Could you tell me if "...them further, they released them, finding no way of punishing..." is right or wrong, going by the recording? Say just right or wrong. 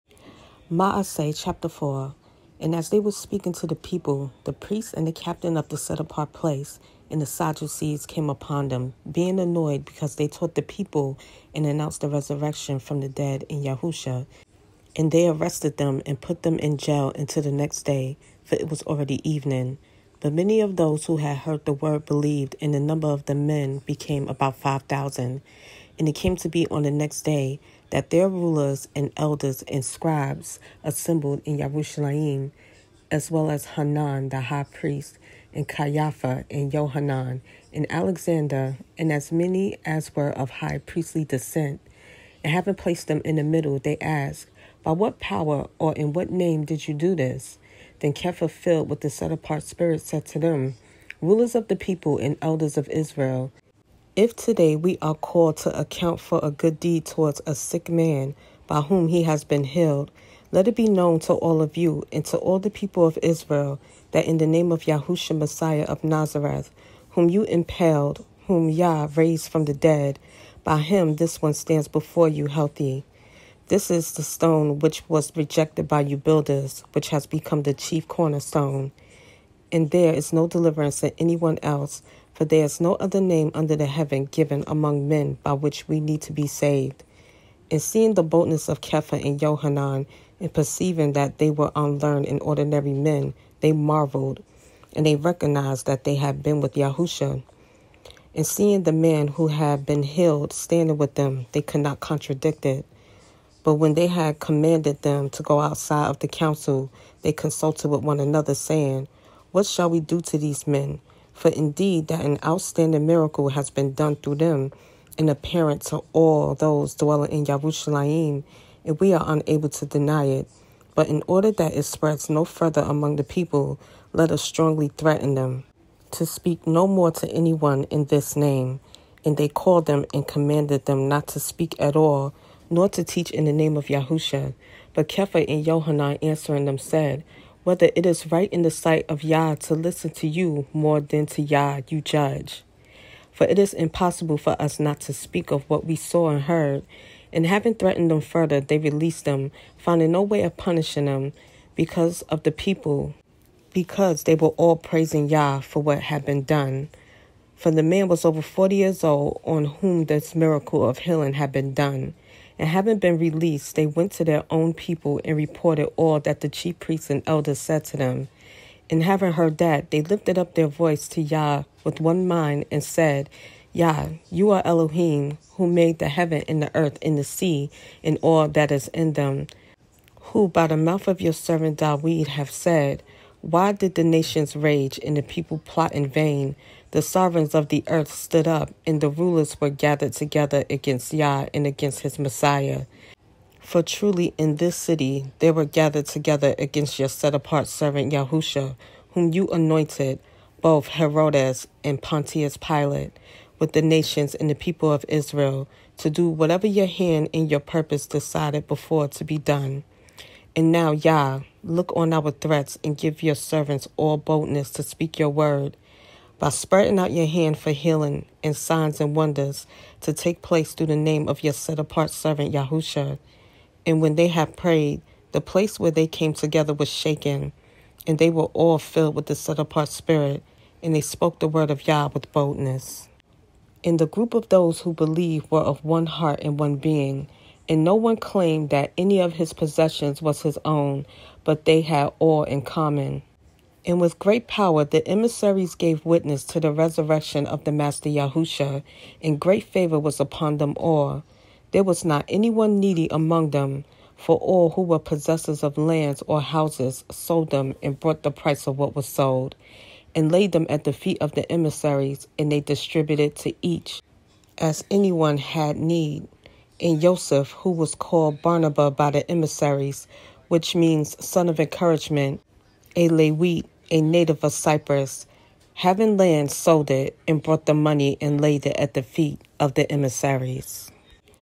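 right.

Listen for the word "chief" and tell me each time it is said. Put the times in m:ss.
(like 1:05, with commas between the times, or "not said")
1:17, 2:46.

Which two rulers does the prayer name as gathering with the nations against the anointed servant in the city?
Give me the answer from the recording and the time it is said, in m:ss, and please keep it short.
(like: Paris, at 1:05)
Herodes and Pontius Pilate, at 3:20.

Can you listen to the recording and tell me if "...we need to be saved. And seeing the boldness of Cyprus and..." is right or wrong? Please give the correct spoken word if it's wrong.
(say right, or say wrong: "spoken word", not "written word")
wrong: "Kepha", not "Cyprus".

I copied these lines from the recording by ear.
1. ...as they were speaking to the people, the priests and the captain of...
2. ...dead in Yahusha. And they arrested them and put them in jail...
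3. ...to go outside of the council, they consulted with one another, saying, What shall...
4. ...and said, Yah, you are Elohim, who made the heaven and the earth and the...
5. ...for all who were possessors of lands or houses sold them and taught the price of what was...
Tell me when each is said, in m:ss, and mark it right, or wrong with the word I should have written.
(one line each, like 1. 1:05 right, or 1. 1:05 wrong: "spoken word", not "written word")
1. 0:02 right
2. 0:13 right
3. 1:45 right
4. 2:52 right
5. 4:14 wrong: "brought", not "taught".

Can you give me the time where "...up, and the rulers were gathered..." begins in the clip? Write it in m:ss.
3:08.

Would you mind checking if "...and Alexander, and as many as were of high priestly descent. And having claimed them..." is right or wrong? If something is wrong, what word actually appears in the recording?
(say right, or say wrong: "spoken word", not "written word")
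wrong: "placed", not "claimed".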